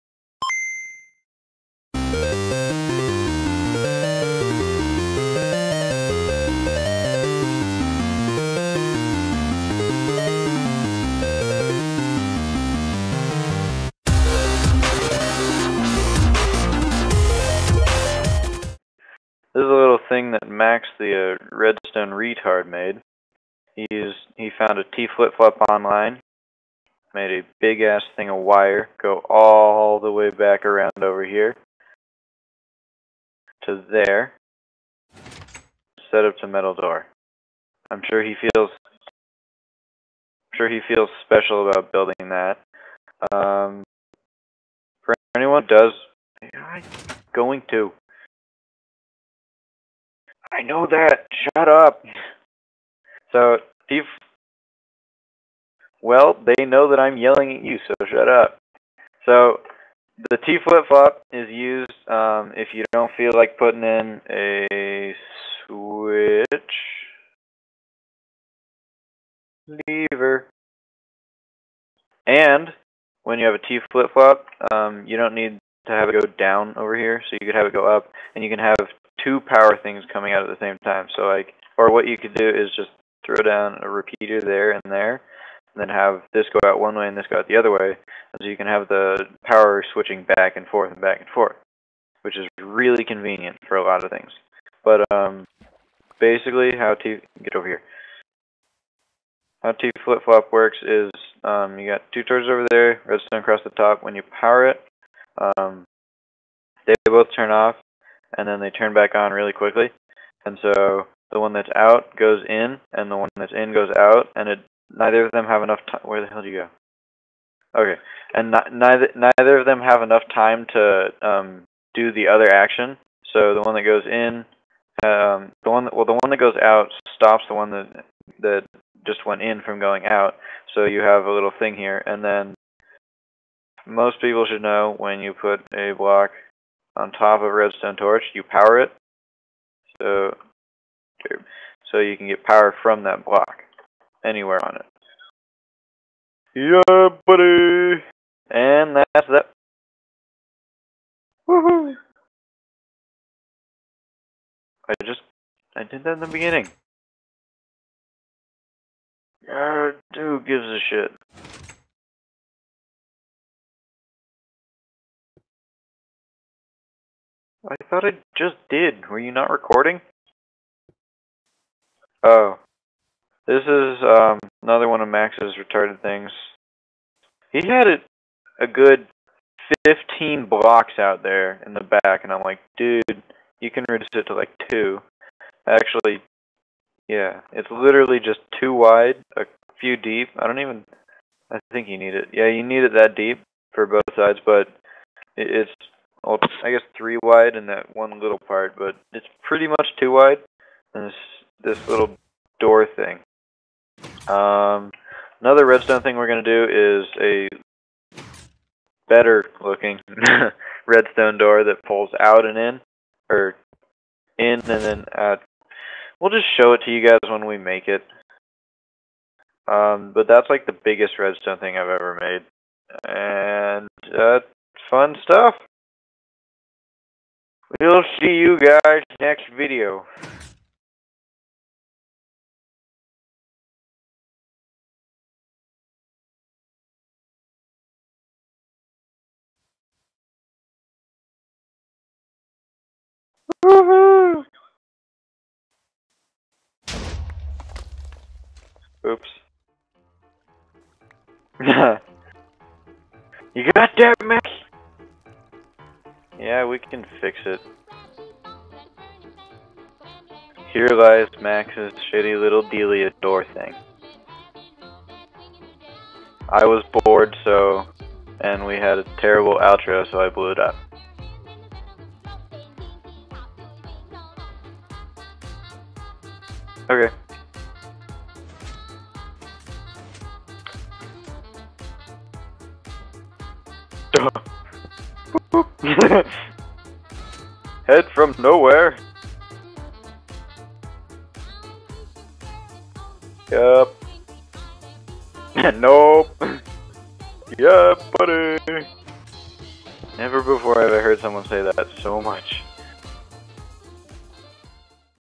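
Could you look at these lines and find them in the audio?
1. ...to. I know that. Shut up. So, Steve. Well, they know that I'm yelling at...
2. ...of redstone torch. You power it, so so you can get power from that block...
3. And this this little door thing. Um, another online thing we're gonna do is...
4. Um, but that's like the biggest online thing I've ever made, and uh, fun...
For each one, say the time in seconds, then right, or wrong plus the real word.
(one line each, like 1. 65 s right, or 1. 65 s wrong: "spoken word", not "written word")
1. 47 s right
2. 137 s right
3. 200 s wrong: "redstone", not "online"
4. 219 s wrong: "redstone", not "online".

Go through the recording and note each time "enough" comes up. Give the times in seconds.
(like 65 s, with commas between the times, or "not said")
115 s, 120 s.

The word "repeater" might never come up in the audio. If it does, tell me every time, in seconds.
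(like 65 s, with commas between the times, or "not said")
83 s.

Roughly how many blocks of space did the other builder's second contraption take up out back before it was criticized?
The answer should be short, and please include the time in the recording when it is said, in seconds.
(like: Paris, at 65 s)
15, at 179 s.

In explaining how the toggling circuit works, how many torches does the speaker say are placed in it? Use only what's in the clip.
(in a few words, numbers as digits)
2.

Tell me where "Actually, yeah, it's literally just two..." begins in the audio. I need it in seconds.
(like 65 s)
185 s.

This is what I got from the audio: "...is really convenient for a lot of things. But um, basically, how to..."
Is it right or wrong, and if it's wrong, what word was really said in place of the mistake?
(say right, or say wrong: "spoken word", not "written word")
right.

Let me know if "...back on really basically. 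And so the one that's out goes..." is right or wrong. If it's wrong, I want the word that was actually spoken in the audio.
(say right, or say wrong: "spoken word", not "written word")
wrong: "quickly", not "basically".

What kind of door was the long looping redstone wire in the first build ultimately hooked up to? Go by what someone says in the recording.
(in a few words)
Metal door.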